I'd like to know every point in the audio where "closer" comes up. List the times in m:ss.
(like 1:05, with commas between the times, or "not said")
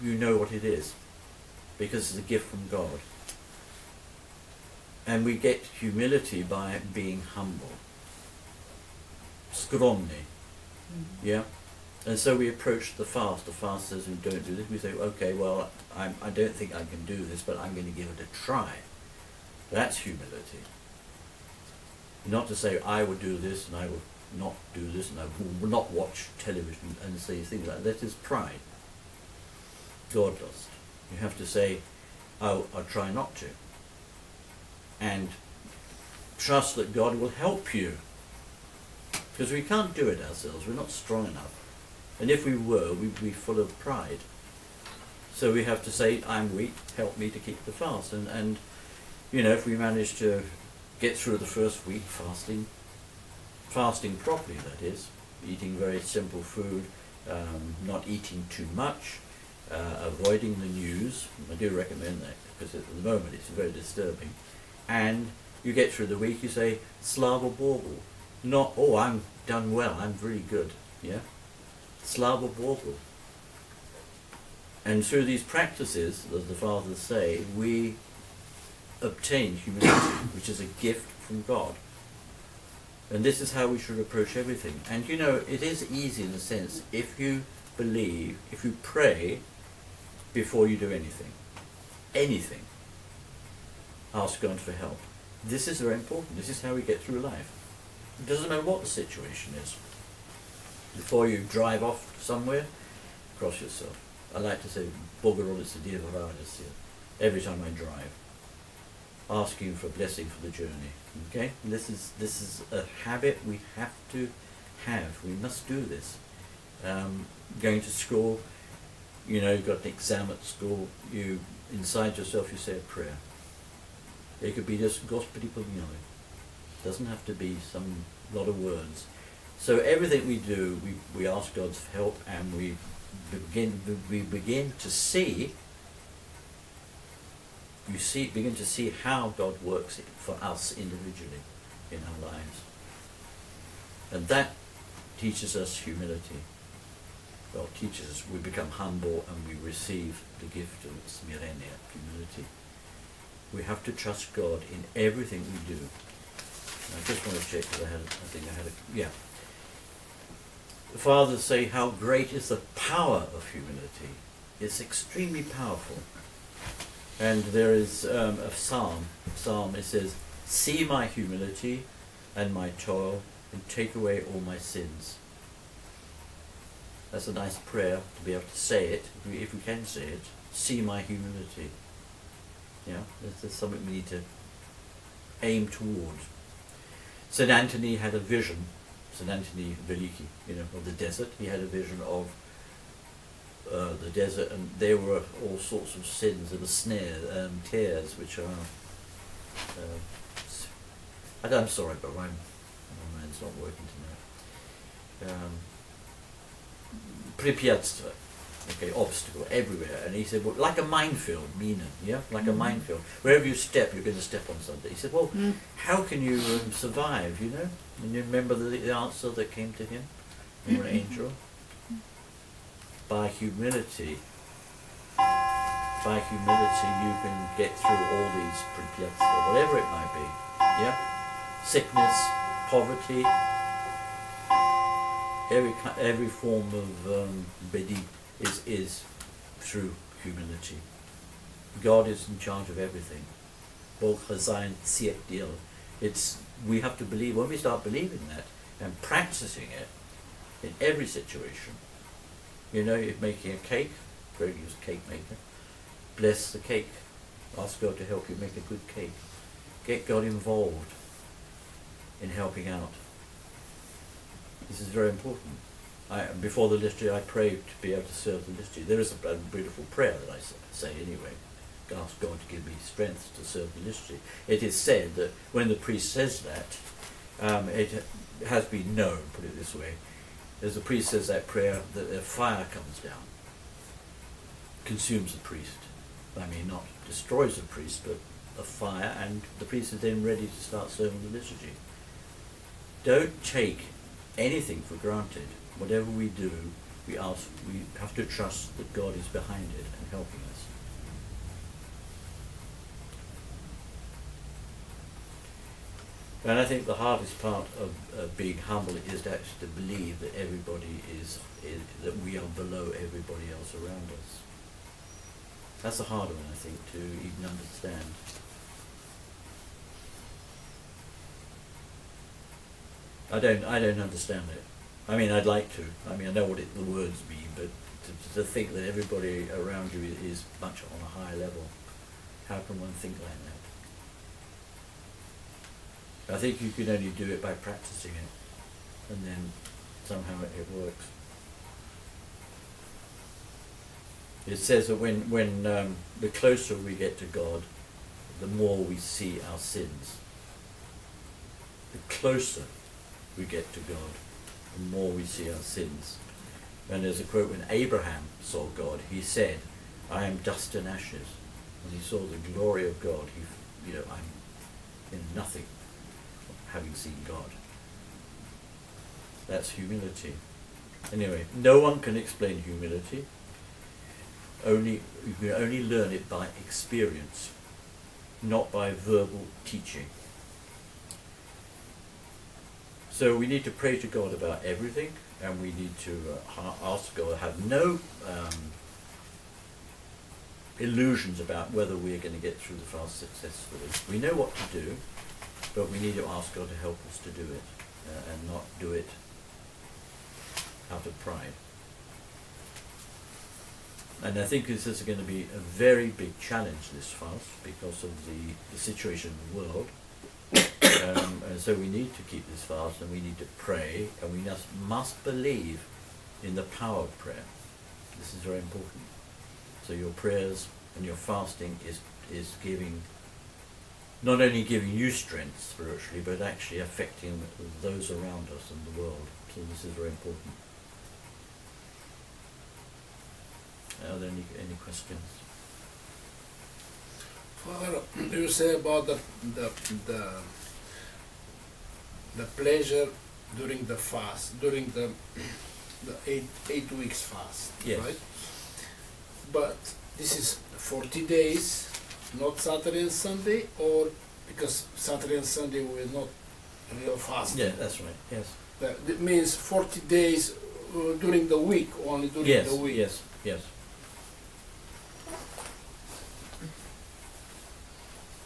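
5:46, 5:52.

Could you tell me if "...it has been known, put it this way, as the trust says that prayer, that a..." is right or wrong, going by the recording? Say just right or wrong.
wrong.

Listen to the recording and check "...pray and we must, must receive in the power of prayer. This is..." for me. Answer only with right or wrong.
wrong.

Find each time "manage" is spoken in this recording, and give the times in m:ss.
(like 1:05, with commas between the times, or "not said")
0:49.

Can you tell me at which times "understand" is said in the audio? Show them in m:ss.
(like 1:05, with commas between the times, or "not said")
5:17, 5:23.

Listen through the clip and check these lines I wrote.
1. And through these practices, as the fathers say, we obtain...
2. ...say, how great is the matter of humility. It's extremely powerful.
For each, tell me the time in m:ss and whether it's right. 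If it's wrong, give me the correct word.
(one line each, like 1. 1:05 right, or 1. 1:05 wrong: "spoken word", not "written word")
1. 1:14 right
2. 2:41 wrong: "power", not "matter".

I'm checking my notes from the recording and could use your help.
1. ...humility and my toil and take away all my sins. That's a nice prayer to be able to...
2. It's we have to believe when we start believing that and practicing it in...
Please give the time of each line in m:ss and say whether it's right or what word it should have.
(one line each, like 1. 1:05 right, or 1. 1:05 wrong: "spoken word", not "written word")
1. 2:51 right
2. 4:06 right.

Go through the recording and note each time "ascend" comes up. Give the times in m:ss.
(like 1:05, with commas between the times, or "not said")
not said.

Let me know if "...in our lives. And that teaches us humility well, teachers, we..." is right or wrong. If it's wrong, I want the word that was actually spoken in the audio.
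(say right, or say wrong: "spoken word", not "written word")
right.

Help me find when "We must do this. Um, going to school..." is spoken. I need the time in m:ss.
1:55.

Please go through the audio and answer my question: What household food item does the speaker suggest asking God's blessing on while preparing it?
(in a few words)
A cake.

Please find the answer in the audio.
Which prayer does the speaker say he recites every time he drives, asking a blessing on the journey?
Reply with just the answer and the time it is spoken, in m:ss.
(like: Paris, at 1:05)
Bogorodice Dievaranis, at 1:45.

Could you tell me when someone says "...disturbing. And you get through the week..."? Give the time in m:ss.
1:03.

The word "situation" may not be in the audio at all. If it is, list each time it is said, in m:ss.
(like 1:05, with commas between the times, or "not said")
1:38, 4:11, 6:48.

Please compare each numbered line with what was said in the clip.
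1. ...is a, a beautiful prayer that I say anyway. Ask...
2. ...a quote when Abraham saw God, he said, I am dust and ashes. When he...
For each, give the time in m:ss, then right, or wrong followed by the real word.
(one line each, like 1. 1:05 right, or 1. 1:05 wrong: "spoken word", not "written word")
1. 4:28 right
2. 5:57 right.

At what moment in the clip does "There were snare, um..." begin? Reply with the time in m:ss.
3:16.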